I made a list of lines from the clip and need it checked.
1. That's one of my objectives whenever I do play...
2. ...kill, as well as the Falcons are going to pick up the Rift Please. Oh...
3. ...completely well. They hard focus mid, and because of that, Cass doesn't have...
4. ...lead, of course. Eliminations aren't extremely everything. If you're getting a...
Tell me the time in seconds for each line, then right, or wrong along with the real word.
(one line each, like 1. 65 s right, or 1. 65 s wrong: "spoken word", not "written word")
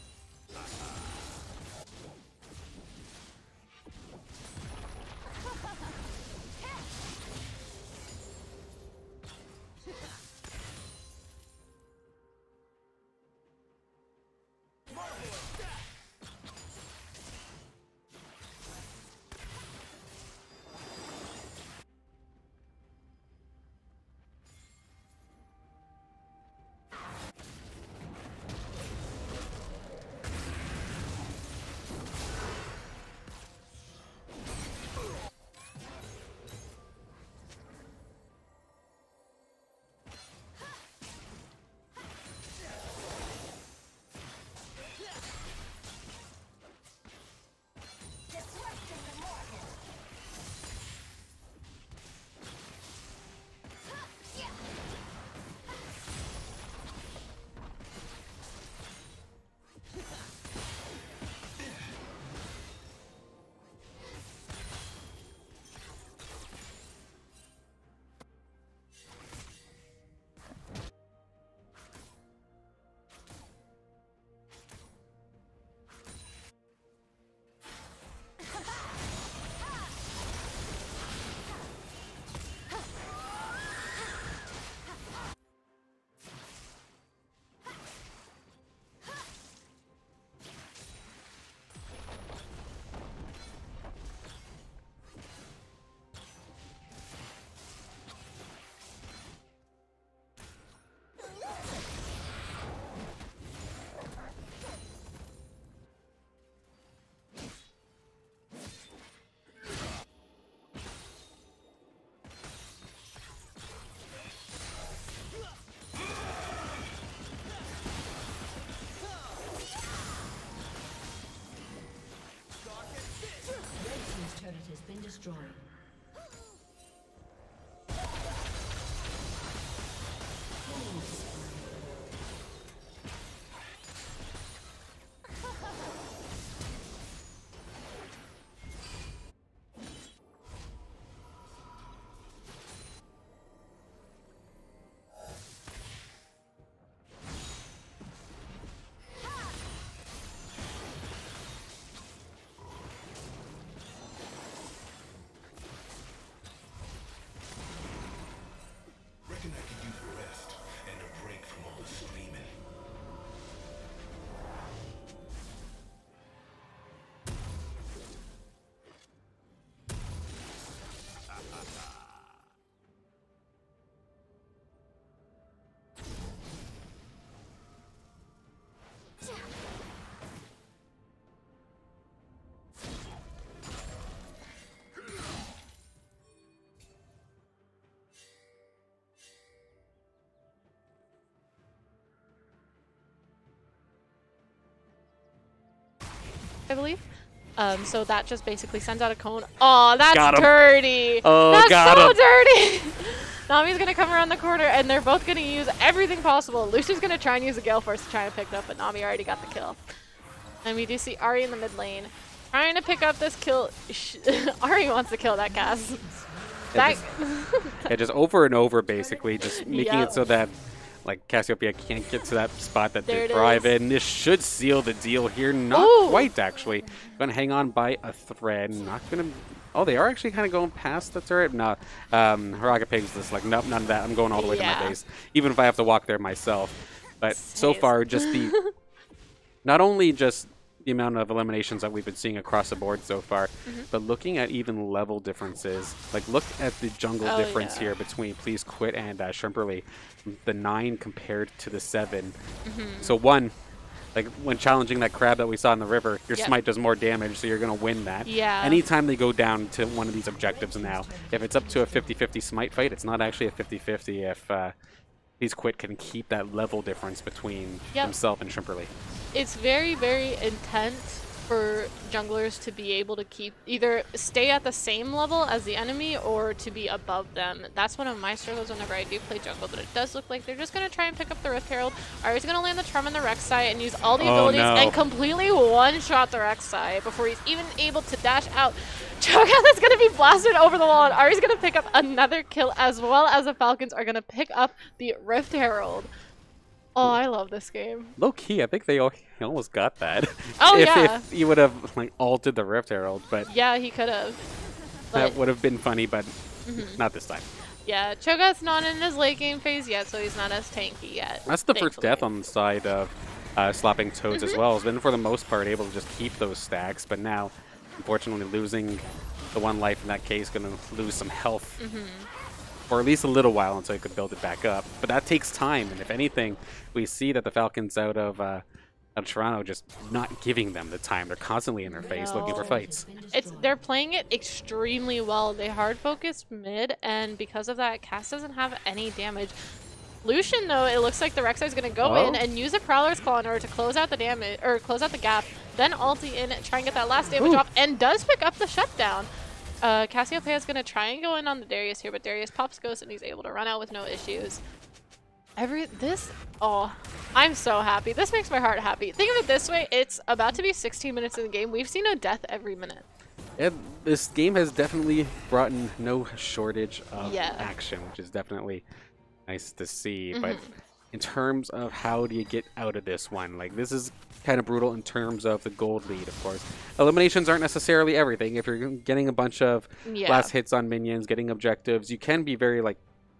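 1. 277 s wrong: "struggles", not "objectives"
2. 292 s wrong: "Herald", not "Please"
3. 334 s wrong: "extremely", not "completely"
4. 376 s wrong: "necessarily", not "extremely".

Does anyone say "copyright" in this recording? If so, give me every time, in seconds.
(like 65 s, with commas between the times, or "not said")
not said.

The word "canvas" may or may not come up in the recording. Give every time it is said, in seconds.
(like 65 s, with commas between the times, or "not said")
not said.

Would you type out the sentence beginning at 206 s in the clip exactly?
Lucian's gonna try and use a Gale Force to try and pick it up, but Nami already got the kill.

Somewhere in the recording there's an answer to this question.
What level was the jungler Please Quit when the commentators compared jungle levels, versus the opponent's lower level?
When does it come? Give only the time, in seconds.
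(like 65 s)
250 s.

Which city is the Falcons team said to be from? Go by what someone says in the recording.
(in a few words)
Toronto.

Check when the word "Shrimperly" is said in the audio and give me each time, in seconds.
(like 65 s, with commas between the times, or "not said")
249 s, 268 s.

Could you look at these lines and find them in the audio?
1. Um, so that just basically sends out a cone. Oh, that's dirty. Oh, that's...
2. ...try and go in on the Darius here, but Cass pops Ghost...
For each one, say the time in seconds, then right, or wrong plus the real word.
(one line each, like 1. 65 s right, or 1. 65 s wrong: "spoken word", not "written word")
1. 197 s right
2. 350 s wrong: "Darius", not "Cass".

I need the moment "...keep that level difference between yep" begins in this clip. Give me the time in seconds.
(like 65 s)
265 s.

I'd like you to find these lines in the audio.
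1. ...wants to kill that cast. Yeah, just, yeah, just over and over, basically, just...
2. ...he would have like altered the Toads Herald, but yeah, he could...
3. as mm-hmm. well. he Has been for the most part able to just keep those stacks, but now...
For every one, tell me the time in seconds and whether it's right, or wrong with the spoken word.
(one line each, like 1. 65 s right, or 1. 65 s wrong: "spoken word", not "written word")
1. 214 s right
2. 301 s wrong: "Rift", not "Toads"
3. 314 s right.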